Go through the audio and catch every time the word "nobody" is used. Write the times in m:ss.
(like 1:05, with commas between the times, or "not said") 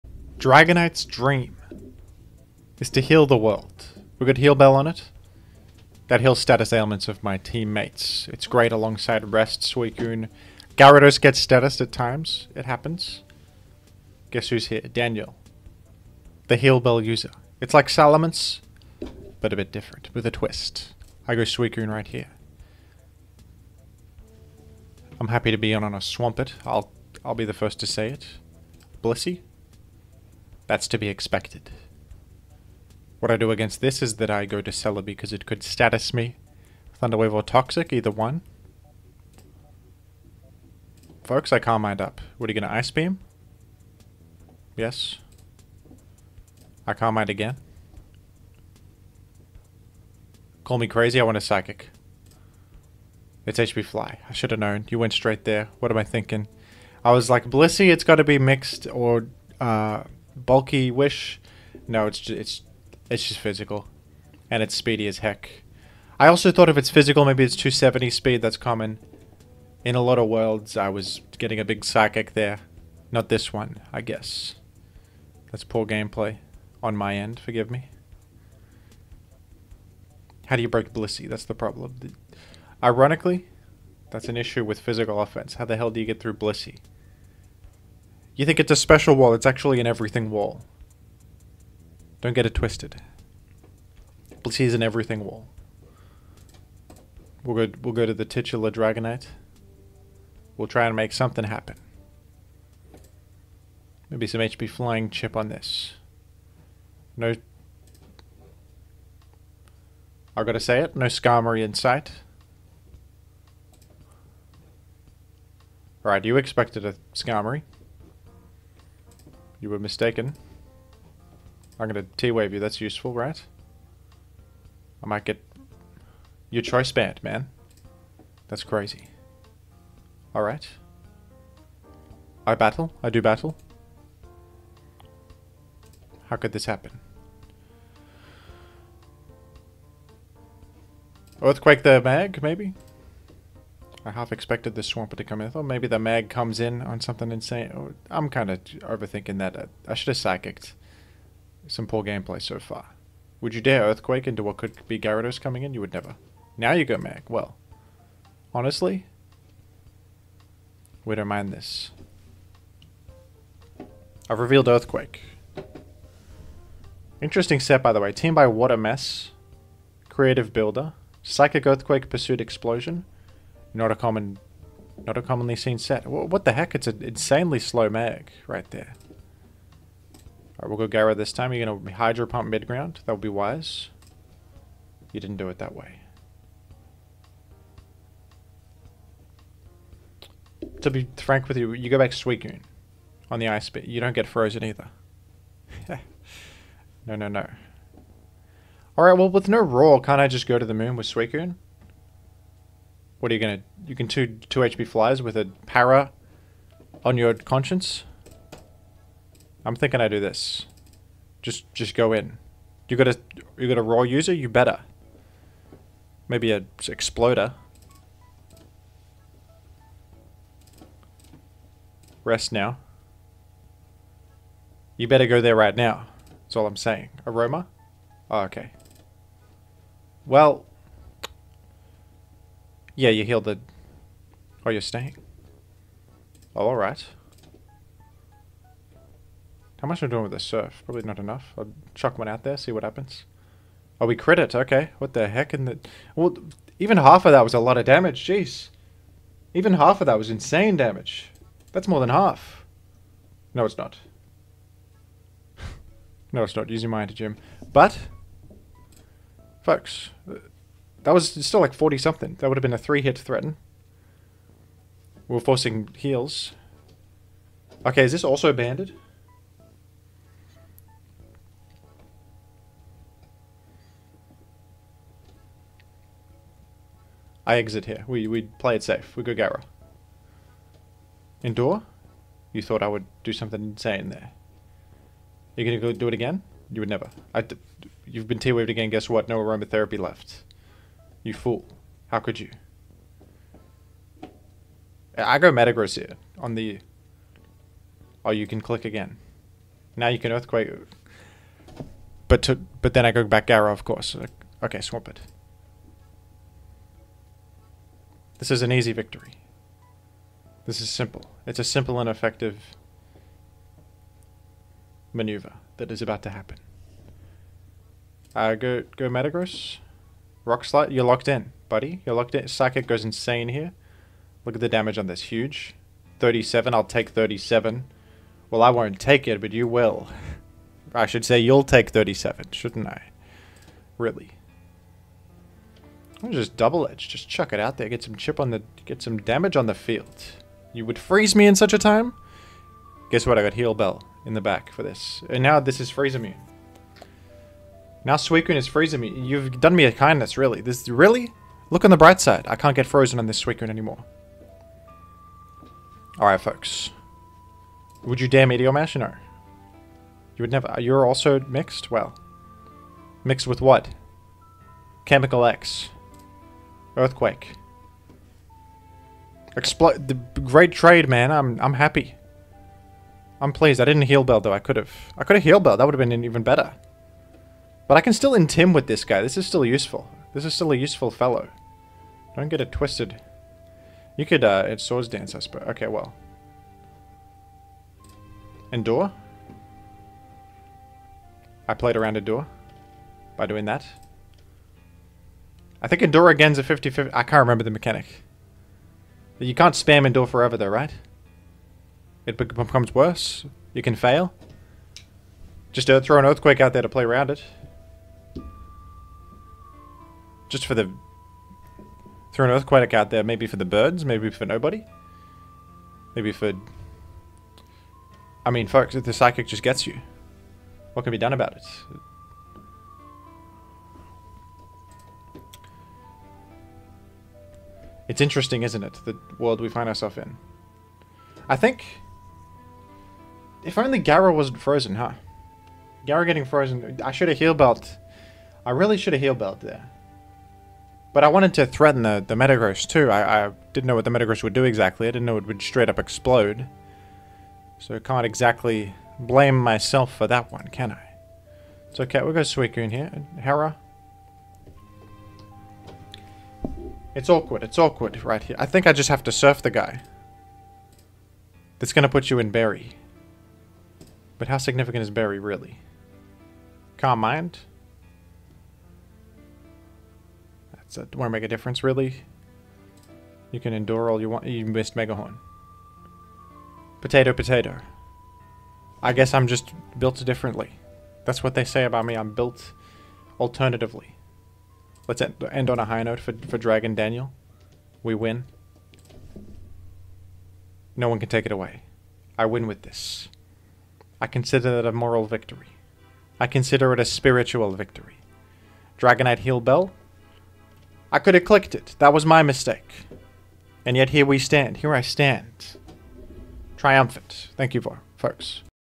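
6:54.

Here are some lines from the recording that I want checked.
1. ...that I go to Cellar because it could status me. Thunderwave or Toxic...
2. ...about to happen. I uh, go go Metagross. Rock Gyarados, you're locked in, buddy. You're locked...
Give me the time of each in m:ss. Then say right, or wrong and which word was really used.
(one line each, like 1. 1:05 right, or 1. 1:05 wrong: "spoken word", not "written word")
1. 0:34 right
2. 5:16 wrong: "Slide", not "Gyarados".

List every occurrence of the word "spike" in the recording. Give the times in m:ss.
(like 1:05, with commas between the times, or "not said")
not said.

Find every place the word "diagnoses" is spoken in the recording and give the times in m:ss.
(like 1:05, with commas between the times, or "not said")
not said.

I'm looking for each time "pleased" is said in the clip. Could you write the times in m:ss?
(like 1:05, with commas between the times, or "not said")
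6:13.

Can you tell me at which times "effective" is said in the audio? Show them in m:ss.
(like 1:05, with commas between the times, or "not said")
5:12.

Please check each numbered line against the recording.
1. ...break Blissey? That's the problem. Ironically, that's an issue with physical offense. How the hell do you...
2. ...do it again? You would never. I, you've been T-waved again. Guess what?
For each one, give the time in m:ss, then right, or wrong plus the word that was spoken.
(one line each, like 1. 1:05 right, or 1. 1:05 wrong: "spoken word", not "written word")
1. 1:20 right
2. 4:45 right.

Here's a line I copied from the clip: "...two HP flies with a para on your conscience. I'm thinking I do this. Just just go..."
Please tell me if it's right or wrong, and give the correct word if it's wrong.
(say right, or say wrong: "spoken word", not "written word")
right.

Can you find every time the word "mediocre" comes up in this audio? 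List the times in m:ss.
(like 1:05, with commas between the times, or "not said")
not said.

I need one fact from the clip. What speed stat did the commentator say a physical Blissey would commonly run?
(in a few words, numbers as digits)
270.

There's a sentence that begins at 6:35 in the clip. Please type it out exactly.
I think Endure is a 50-50.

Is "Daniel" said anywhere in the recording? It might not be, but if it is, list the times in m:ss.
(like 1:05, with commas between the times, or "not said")
0:14, 8:06.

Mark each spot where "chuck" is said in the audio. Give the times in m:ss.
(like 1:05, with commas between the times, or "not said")
4:01, 5:37.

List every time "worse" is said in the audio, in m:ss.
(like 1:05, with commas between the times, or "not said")
6:42.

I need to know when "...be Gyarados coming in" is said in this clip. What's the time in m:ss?
2:34.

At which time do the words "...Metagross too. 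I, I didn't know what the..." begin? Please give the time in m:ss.
7:22.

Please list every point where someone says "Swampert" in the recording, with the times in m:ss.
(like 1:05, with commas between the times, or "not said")
0:25, 2:24.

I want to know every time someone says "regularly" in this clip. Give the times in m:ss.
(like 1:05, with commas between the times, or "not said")
not said.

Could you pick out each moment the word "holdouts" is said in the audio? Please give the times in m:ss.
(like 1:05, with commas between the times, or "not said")
not said.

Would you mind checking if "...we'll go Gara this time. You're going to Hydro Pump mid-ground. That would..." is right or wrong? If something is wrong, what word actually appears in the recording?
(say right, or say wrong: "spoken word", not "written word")
right.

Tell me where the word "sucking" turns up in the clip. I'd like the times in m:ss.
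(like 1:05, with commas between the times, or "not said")
not said.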